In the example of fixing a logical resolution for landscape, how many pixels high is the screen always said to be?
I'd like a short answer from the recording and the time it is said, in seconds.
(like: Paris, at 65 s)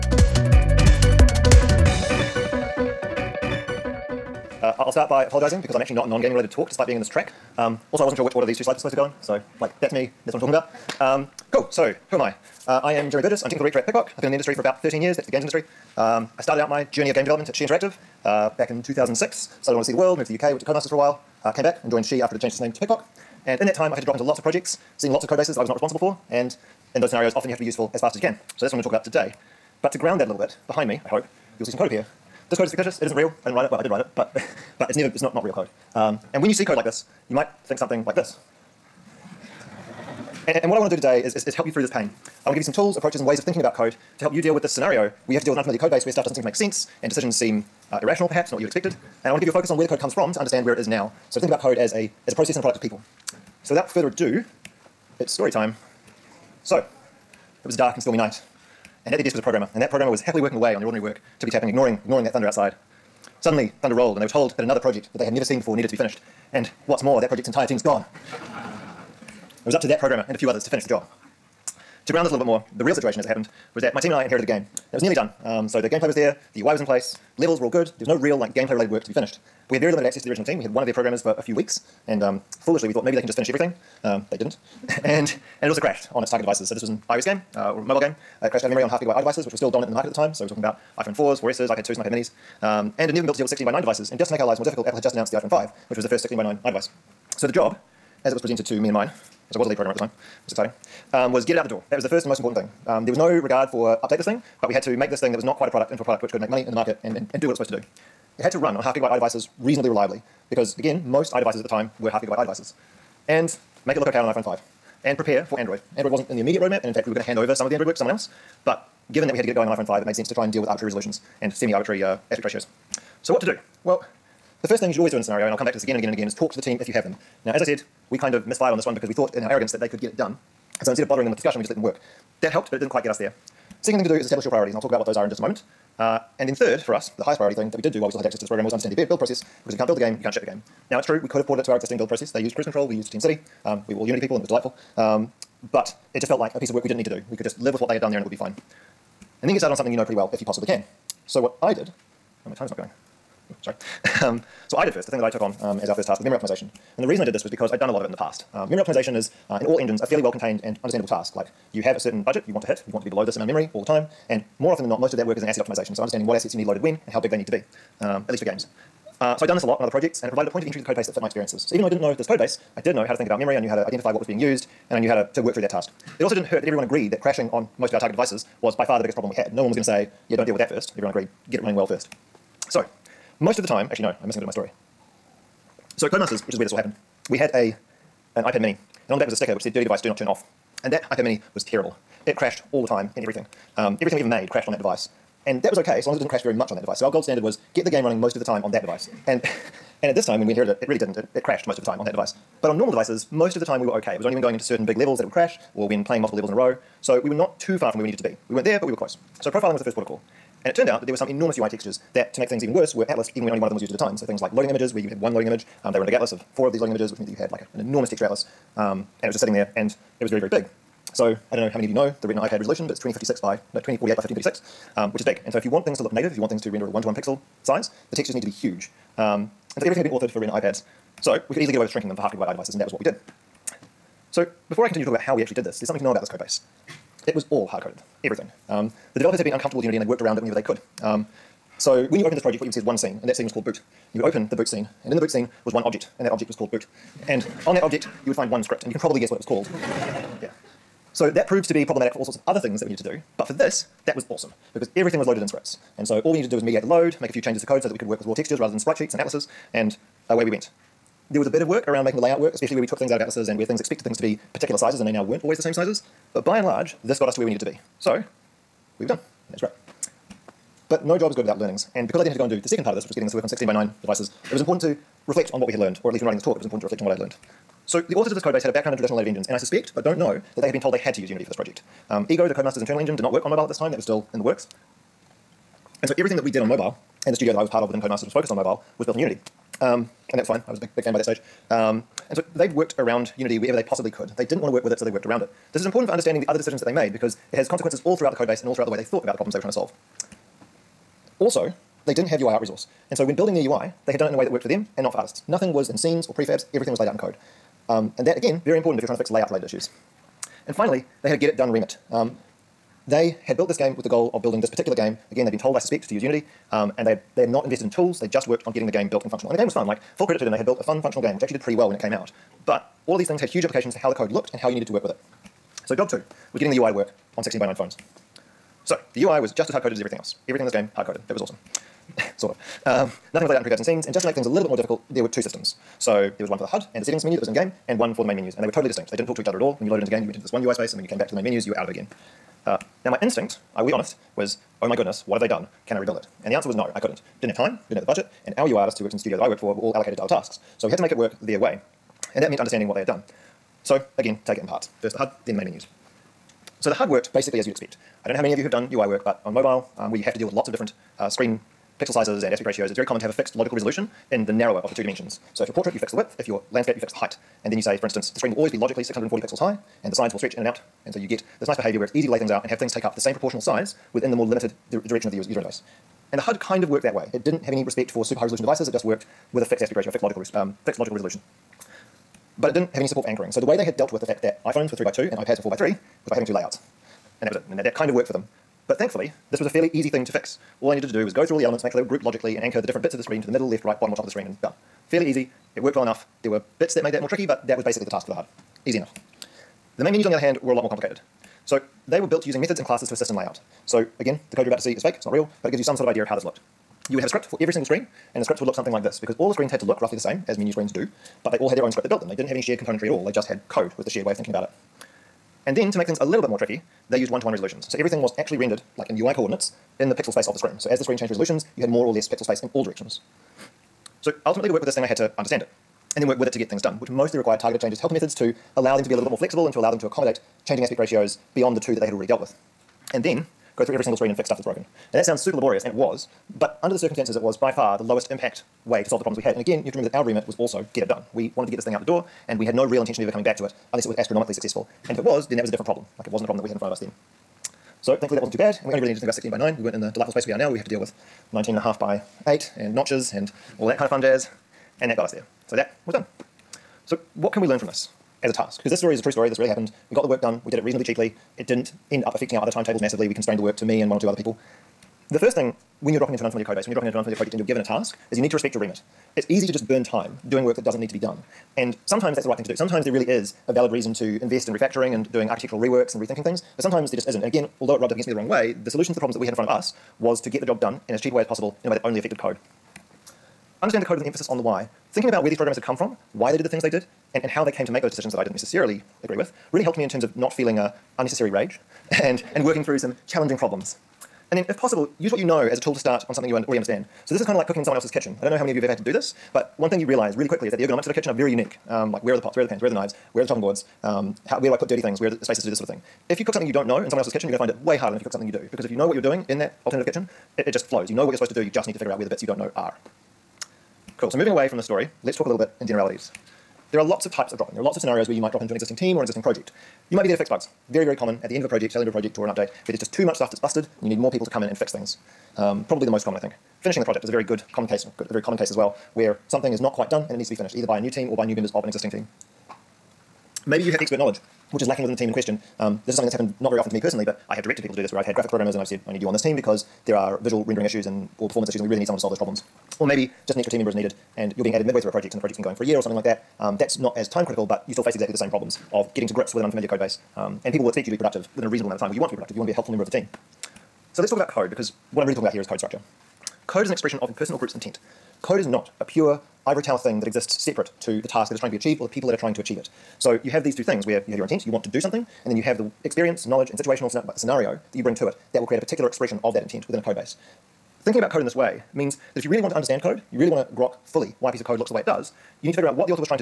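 640, at 369 s.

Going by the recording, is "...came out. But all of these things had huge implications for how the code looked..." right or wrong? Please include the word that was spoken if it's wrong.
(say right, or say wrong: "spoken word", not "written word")
right.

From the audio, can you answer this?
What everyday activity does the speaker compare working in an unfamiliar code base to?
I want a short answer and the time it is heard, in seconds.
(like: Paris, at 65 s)
cooking in someone else's kitchen, at 497 s.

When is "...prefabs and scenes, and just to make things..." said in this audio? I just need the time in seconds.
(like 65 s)
333 s.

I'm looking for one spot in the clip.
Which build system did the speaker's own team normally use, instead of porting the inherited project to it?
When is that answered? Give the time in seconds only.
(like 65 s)
143 s.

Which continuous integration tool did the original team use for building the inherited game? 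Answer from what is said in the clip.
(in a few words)
CruiseControl.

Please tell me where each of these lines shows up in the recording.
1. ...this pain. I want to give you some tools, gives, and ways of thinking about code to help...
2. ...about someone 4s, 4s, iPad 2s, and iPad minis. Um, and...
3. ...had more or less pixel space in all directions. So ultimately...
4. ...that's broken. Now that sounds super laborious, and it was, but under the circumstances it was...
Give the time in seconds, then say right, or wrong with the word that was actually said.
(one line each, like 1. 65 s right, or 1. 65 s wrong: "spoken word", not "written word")
1. 41 s wrong: "approaches", not "gives"
2. 90 s wrong: "iPhone", not "someone"
3. 421 s right
4. 434 s right.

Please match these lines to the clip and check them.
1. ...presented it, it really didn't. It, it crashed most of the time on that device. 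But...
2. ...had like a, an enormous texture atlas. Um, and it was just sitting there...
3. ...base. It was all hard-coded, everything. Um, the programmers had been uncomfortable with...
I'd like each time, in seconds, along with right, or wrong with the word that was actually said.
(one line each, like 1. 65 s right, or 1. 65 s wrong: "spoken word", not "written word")
1. 200 s wrong: "inherited", not "presented"
2. 217 s right
3. 236 s wrong: "developers", not "programmers".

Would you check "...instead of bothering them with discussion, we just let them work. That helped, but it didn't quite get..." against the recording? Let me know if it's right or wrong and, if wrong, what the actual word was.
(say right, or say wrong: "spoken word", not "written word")
right.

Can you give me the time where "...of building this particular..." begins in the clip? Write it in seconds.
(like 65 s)
314 s.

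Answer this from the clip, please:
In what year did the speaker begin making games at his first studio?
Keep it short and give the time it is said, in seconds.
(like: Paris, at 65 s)
2006, at 18 s.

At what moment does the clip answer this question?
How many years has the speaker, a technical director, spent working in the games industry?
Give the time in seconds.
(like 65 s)
14 s.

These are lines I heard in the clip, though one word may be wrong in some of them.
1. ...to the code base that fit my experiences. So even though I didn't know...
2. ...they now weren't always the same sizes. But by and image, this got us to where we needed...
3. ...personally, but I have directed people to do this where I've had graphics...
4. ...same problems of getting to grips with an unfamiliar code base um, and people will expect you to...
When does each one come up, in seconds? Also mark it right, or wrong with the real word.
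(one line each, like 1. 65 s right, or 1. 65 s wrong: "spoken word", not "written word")
1. 170 s right
2. 265 s wrong: "large", not "image"
3. 536 s right
4. 548 s right.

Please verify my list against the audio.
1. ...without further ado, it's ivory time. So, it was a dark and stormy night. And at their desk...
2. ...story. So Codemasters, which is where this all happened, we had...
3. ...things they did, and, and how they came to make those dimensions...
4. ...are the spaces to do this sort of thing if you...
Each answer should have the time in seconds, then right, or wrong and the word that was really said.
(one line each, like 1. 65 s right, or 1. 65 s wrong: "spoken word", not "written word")
1. 53 s wrong: "story", not "ivory"
2. 184 s right
3. 486 s wrong: "decisions", not "dimensions"
4. 505 s right.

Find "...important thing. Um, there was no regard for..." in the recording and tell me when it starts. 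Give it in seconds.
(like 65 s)
102 s.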